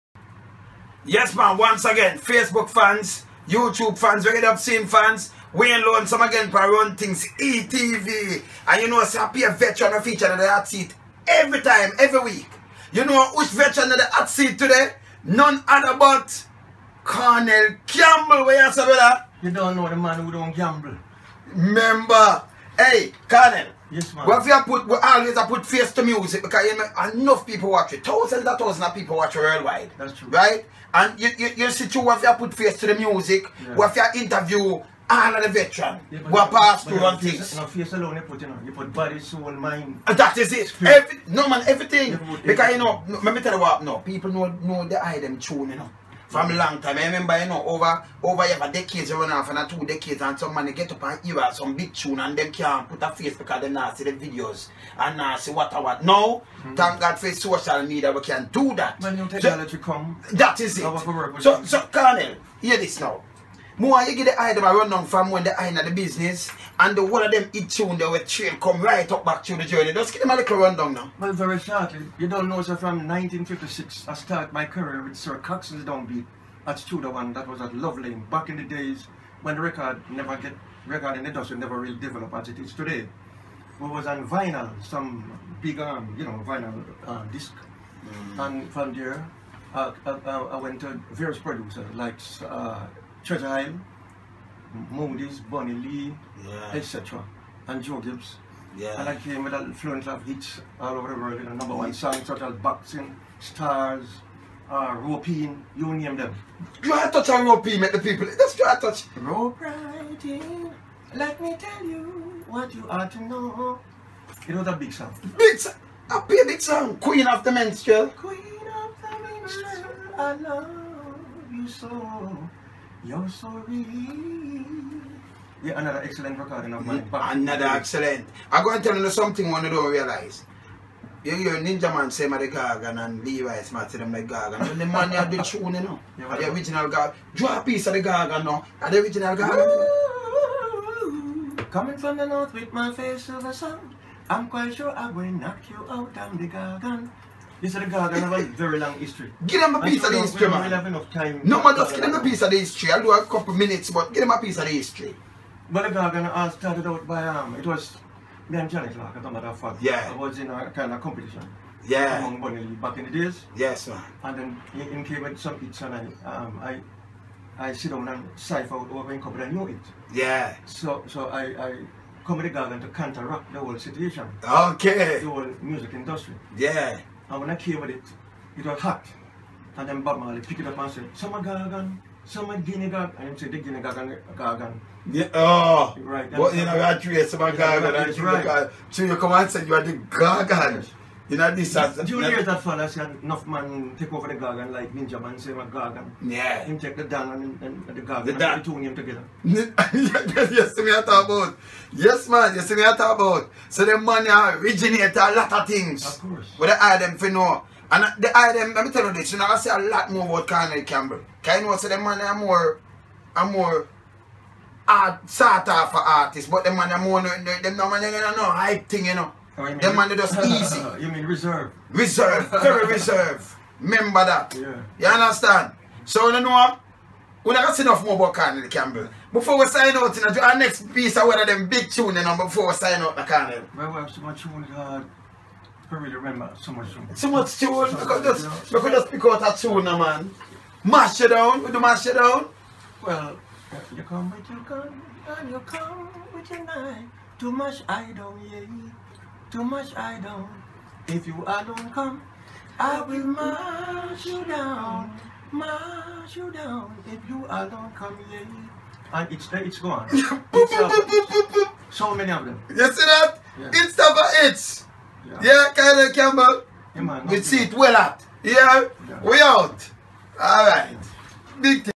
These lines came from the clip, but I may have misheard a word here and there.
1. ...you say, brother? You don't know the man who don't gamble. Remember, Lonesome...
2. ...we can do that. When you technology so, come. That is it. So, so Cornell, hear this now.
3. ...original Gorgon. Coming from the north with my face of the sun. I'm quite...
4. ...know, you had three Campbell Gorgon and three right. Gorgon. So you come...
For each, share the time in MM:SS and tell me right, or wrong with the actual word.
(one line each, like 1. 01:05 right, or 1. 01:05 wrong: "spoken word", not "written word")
1. 00:18 wrong: "Hey", not "Lonesome"
2. 00:58 right
3. 02:19 right
4. 03:06 wrong: "Summer", not "Campbell".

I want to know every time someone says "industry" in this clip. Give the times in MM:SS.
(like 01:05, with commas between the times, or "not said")
01:21, 02:55.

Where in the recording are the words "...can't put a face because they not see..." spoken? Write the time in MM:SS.
00:52.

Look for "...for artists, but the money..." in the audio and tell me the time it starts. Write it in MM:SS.
03:35.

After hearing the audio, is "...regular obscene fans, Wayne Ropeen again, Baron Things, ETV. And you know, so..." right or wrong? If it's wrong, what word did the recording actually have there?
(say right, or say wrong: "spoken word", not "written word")
wrong: "Lonesome", not "Ropeen".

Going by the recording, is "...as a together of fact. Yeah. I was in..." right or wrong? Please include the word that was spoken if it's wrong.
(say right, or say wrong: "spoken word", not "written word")
wrong: "matter", not "together".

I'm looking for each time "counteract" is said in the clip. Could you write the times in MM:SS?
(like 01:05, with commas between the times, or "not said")
02:52.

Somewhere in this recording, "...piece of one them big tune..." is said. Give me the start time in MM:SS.
03:50.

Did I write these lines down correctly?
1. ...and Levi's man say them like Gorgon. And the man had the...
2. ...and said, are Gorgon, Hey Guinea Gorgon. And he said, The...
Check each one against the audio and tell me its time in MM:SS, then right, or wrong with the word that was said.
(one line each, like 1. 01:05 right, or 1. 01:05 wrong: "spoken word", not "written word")
1. 02:13 right
2. 03:00 wrong: "Summer", not "Hey".